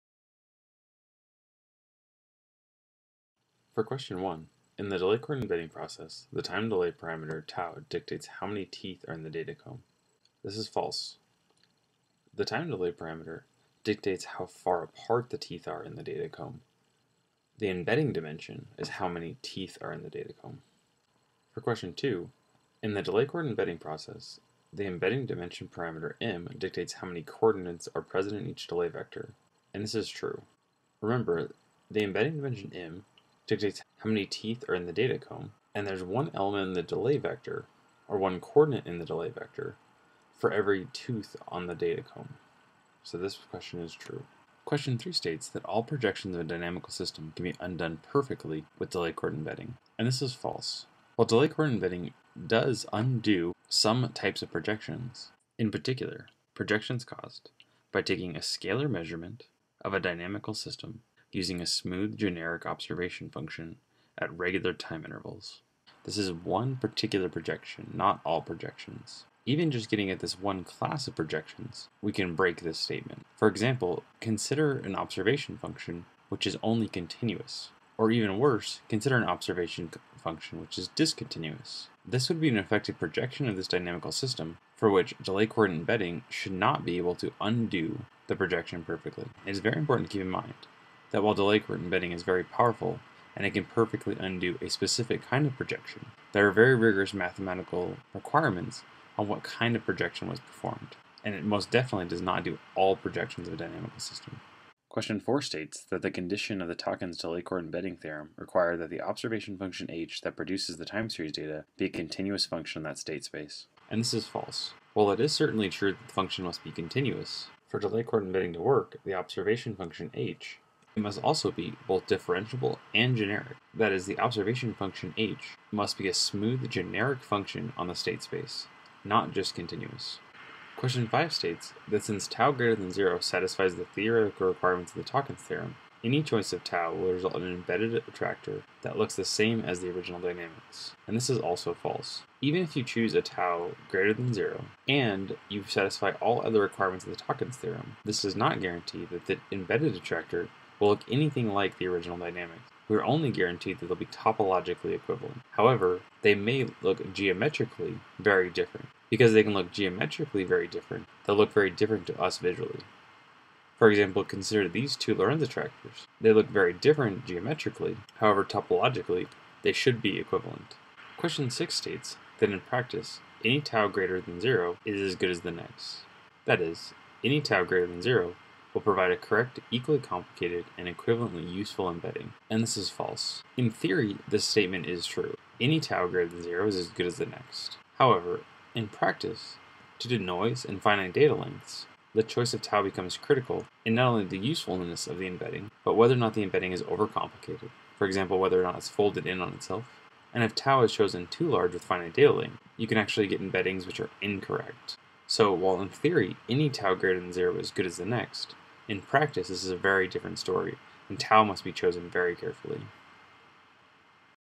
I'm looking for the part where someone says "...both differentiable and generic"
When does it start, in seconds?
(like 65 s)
121 s.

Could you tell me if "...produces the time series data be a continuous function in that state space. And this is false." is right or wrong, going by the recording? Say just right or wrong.
right.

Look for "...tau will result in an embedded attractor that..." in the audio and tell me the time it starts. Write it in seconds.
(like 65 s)
136 s.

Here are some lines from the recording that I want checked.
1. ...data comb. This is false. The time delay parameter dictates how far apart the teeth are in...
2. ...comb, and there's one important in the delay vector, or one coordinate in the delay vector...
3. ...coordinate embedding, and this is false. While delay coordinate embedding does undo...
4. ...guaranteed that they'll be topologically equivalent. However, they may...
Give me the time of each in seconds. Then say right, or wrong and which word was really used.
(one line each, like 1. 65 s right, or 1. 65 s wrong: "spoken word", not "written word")
1. 9 s right
2. 35 s wrong: "element", not "important"
3. 49 s right
4. 153 s right.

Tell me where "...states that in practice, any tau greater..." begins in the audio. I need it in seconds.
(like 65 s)
171 s.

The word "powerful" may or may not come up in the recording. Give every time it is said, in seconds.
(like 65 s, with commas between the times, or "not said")
92 s.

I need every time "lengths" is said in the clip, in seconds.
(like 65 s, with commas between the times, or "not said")
191 s, 202 s.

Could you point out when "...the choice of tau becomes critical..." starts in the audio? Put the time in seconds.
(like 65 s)
192 s.